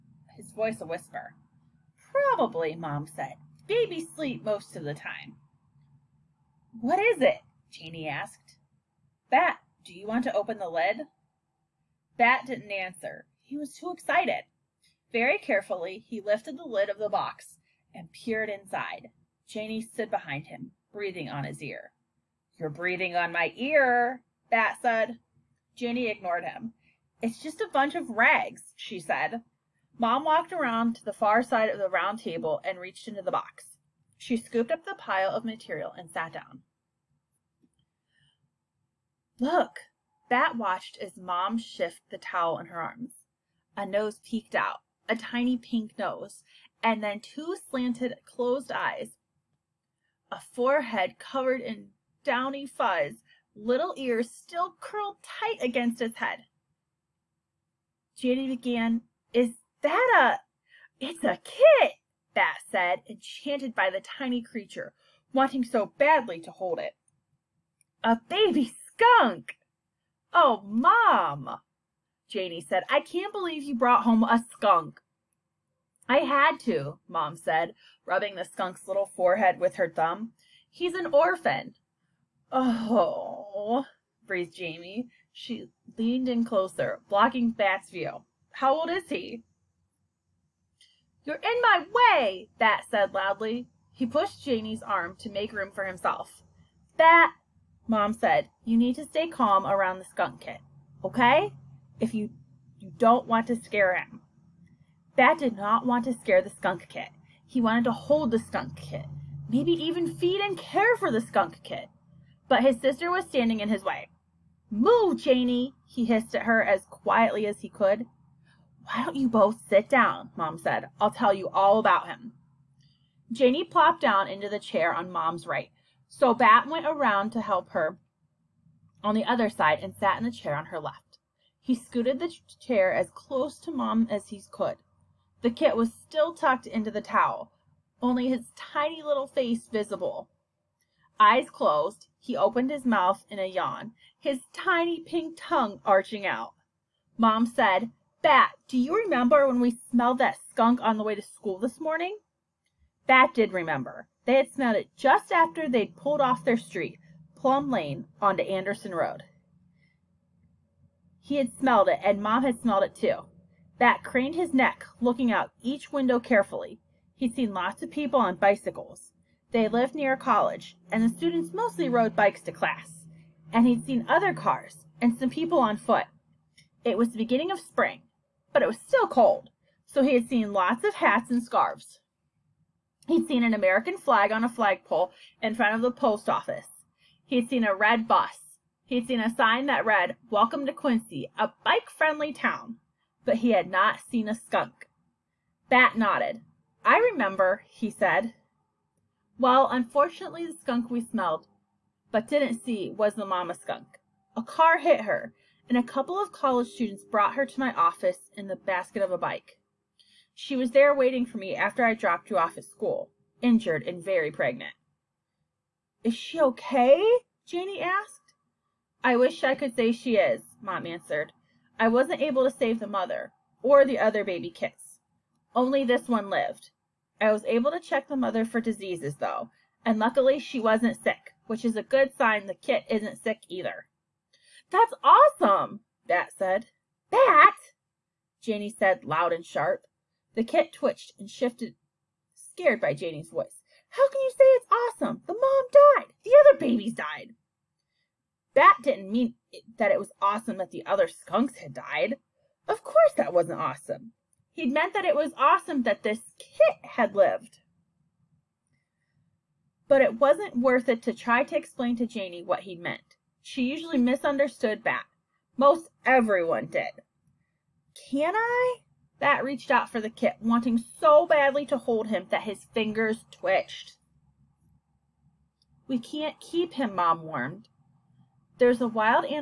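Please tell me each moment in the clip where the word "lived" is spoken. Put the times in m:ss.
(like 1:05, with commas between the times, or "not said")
2:49, 3:46, 4:17.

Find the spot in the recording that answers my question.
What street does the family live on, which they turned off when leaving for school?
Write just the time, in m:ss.
2:37.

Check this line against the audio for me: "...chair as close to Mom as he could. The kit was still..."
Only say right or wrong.
right.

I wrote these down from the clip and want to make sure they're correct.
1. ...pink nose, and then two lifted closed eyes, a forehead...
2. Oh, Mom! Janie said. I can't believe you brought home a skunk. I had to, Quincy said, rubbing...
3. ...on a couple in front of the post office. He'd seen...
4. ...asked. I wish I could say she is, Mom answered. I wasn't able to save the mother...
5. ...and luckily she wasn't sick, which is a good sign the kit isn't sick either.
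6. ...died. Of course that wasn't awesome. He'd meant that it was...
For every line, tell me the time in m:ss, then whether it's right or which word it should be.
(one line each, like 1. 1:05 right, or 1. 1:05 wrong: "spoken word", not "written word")
1. 0:45 wrong: "slanted", not "lifted"
2. 1:10 wrong: "Mom", not "Quincy"
3. 3:04 wrong: "flagpole", not "couple"
4. 3:37 right
5. 3:49 right
6. 4:11 right.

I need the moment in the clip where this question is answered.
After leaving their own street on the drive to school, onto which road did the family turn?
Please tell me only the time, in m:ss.
2:38.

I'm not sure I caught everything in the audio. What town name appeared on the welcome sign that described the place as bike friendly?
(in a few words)
Quincy.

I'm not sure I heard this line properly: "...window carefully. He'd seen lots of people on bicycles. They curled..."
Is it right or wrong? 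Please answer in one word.
wrong.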